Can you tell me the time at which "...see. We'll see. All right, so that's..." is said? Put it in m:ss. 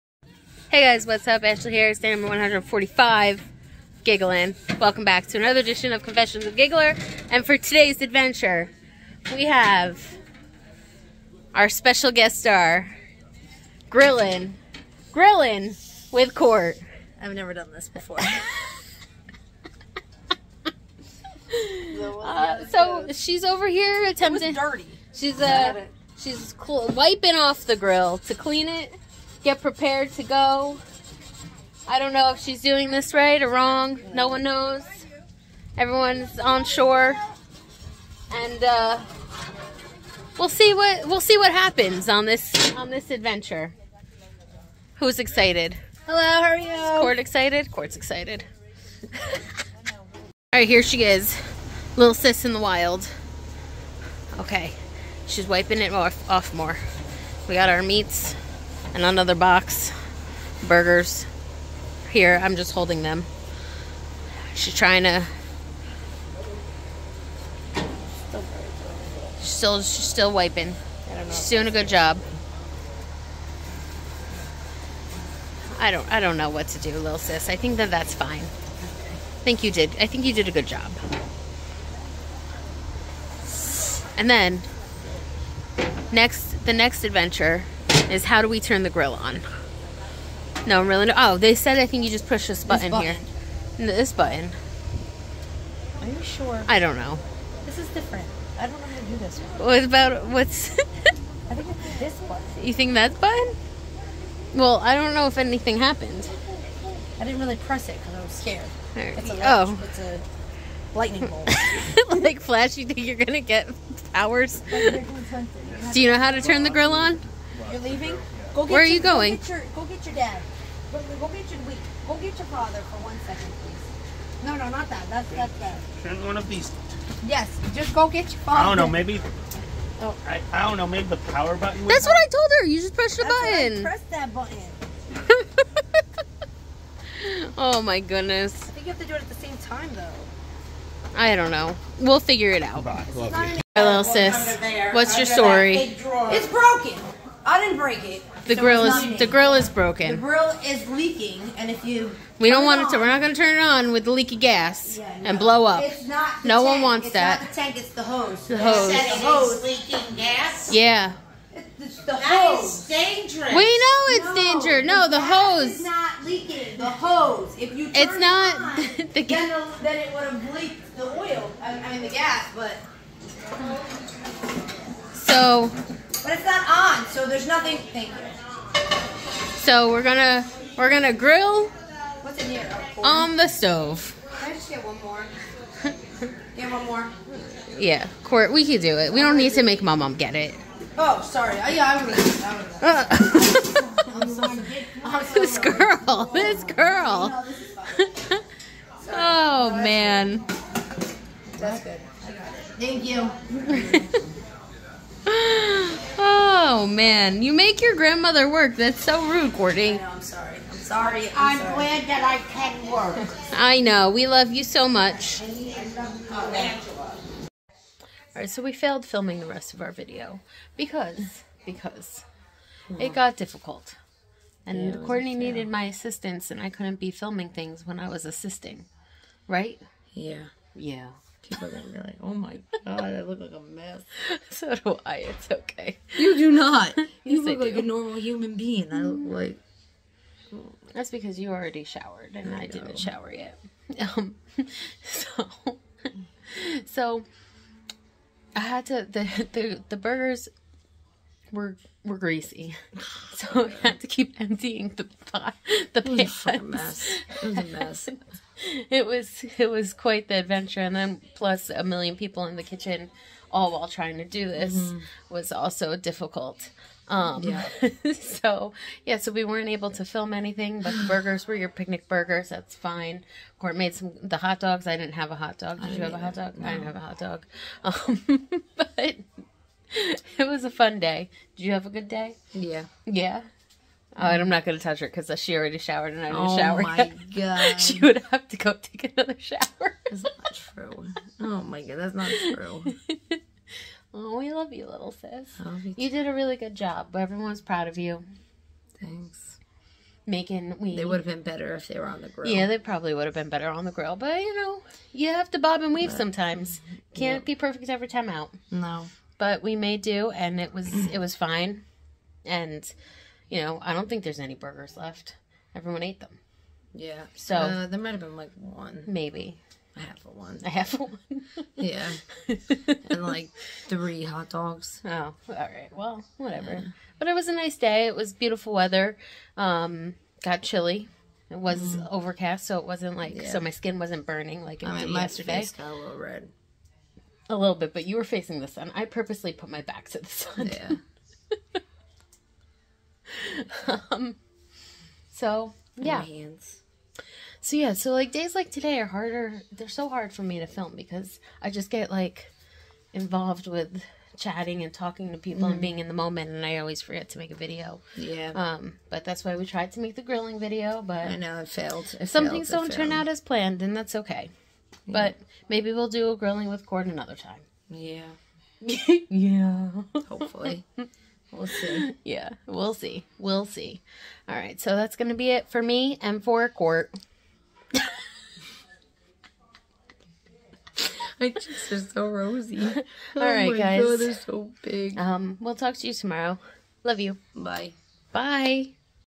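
6:12.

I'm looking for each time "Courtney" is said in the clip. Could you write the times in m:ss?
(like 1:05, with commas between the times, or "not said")
3:29, 3:45.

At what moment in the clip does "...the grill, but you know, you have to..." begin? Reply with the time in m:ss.
5:03.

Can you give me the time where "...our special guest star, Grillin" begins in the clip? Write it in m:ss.
0:11.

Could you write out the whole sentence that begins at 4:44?
Oh, and I'm not going to touch her because she already showered and I didn't oh shower.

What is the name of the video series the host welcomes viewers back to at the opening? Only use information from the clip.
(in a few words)
Confessions of Giggler.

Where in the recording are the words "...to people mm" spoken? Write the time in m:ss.
5:55.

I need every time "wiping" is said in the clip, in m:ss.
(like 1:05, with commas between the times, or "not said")
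0:26, 0:55, 1:10.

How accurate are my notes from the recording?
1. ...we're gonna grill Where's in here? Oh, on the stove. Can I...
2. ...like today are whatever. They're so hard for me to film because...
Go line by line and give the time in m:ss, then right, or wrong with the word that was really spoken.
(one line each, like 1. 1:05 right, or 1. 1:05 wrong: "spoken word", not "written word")
1. 3:00 wrong: "What", not "Where"
2. 5:48 wrong: "harder", not "whatever".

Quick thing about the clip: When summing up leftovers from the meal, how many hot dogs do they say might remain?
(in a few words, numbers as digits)
3.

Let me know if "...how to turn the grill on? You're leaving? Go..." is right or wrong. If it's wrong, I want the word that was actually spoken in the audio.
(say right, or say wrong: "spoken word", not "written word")
right.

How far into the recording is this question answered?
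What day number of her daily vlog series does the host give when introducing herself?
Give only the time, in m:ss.
0:01.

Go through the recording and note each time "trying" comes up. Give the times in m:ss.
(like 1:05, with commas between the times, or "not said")
1:04, 4:23.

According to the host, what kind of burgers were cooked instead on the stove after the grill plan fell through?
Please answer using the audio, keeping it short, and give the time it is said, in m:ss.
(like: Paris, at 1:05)
picnic burgers, at 4:31.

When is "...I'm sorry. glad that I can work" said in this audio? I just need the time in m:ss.
3:31.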